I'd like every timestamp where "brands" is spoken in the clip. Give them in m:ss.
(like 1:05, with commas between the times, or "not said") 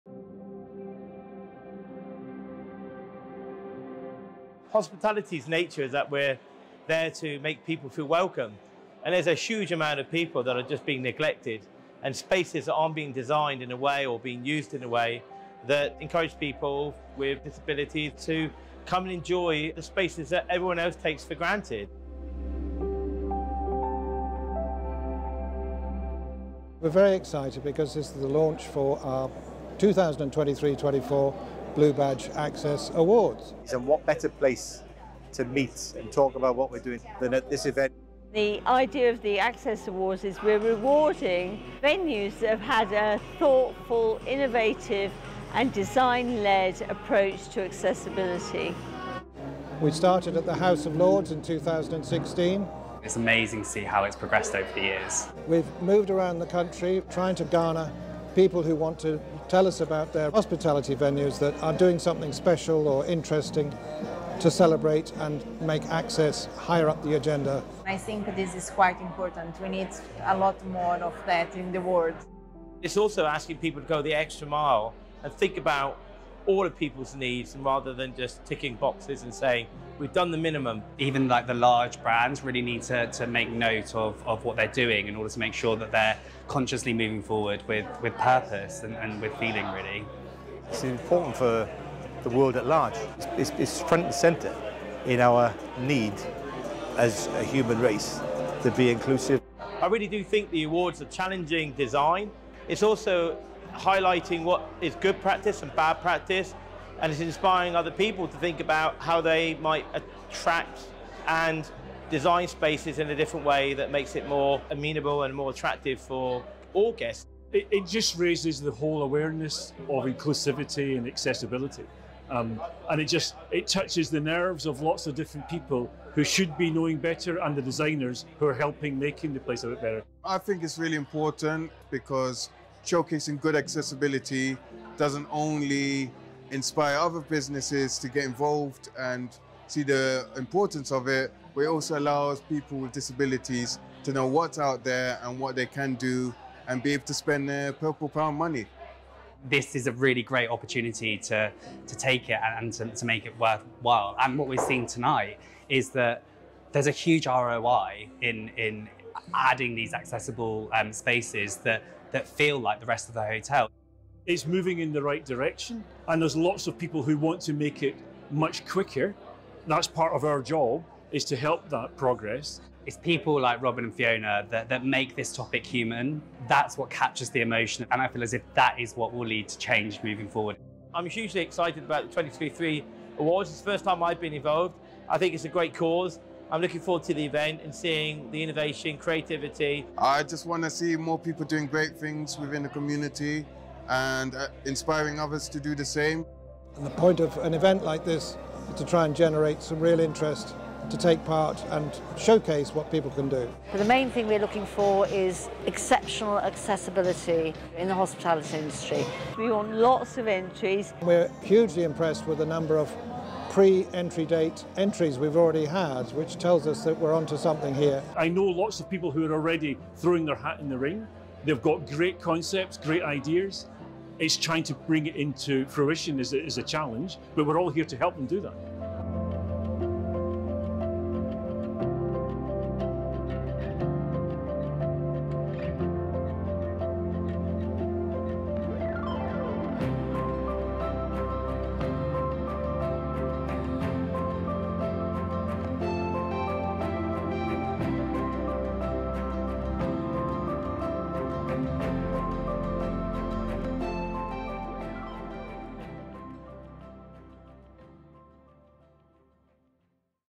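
1:22.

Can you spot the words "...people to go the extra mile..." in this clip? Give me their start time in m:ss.
1:13.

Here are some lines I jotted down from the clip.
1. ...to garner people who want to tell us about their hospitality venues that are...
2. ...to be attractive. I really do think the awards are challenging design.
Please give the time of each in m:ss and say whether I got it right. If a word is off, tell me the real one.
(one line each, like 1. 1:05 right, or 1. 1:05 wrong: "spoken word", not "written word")
1. 0:57 right
2. 1:38 wrong: "inclusive", not "attractive".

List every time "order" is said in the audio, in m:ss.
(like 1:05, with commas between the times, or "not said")
1:25.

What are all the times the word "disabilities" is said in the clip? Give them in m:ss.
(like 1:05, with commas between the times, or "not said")
0:17, 2:22.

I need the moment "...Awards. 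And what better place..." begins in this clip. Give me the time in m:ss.
0:32.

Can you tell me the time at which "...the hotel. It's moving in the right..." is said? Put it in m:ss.
2:43.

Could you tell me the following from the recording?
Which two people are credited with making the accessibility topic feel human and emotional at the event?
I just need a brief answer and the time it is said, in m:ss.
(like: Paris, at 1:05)
Robin and Fiona, at 2:53.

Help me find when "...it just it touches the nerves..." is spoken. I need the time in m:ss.
2:03.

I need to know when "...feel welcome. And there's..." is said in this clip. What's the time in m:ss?
0:07.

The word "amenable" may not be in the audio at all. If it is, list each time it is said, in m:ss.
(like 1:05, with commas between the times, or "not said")
1:54.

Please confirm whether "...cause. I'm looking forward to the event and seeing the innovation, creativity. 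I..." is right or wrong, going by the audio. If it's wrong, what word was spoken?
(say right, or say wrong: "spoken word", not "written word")
right.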